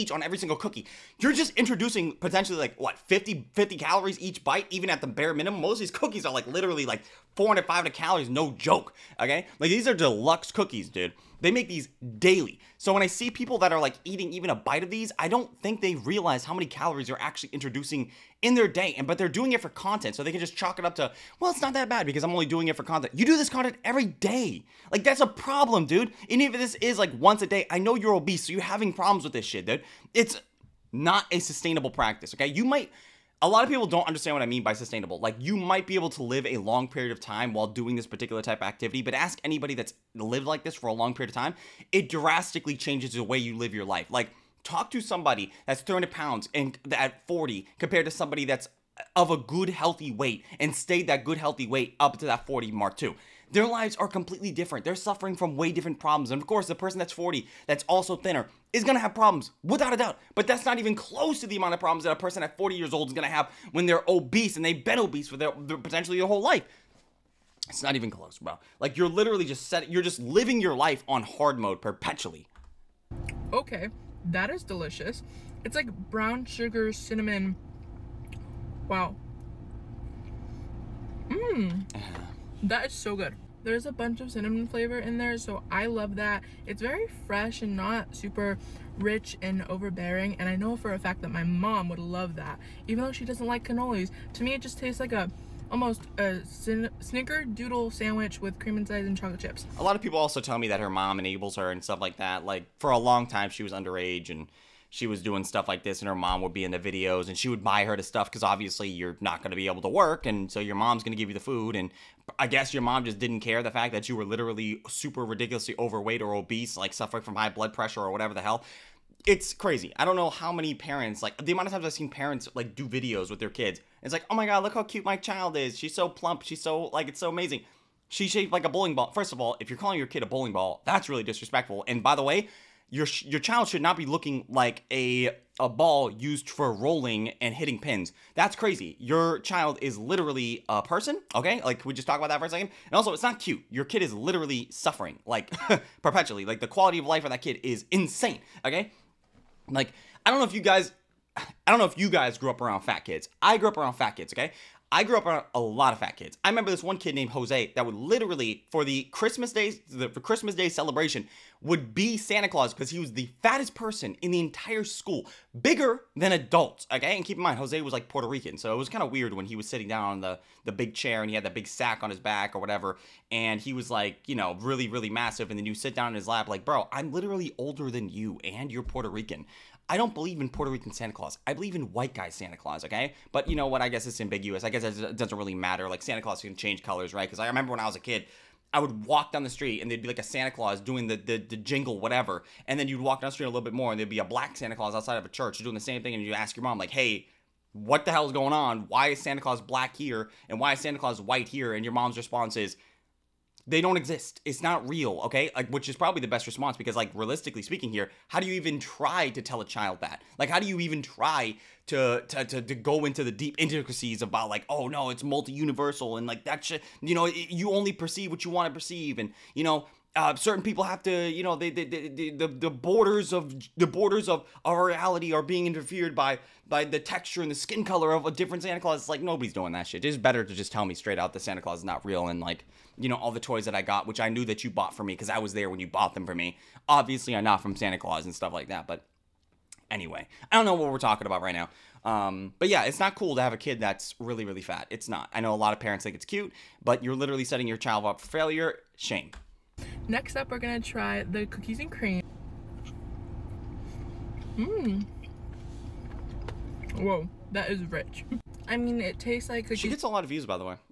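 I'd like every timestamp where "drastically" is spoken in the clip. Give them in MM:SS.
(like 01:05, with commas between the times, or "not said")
00:42.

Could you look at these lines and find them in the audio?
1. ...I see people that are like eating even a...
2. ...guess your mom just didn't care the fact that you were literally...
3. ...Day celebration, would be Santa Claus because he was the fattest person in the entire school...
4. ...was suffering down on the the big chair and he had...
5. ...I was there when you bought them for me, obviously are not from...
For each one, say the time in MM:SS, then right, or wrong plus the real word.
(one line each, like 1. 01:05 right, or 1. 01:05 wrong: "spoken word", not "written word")
1. 00:13 right
2. 01:52 right
3. 02:40 right
4. 02:49 wrong: "sitting", not "suffering"
5. 03:55 right.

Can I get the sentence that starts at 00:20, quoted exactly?
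So they can just chalk it up to, well, it's not that bad because I'm only doing it for content.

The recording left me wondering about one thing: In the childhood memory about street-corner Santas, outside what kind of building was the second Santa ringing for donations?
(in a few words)
A church.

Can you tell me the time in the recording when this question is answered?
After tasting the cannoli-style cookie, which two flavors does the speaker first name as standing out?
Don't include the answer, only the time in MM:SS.
01:16.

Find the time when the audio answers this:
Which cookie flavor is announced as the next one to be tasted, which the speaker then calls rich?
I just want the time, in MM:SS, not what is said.
04:11.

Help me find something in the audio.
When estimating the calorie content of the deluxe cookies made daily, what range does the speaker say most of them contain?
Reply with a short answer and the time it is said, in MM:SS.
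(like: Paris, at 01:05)
400-500 calories, at 00:07.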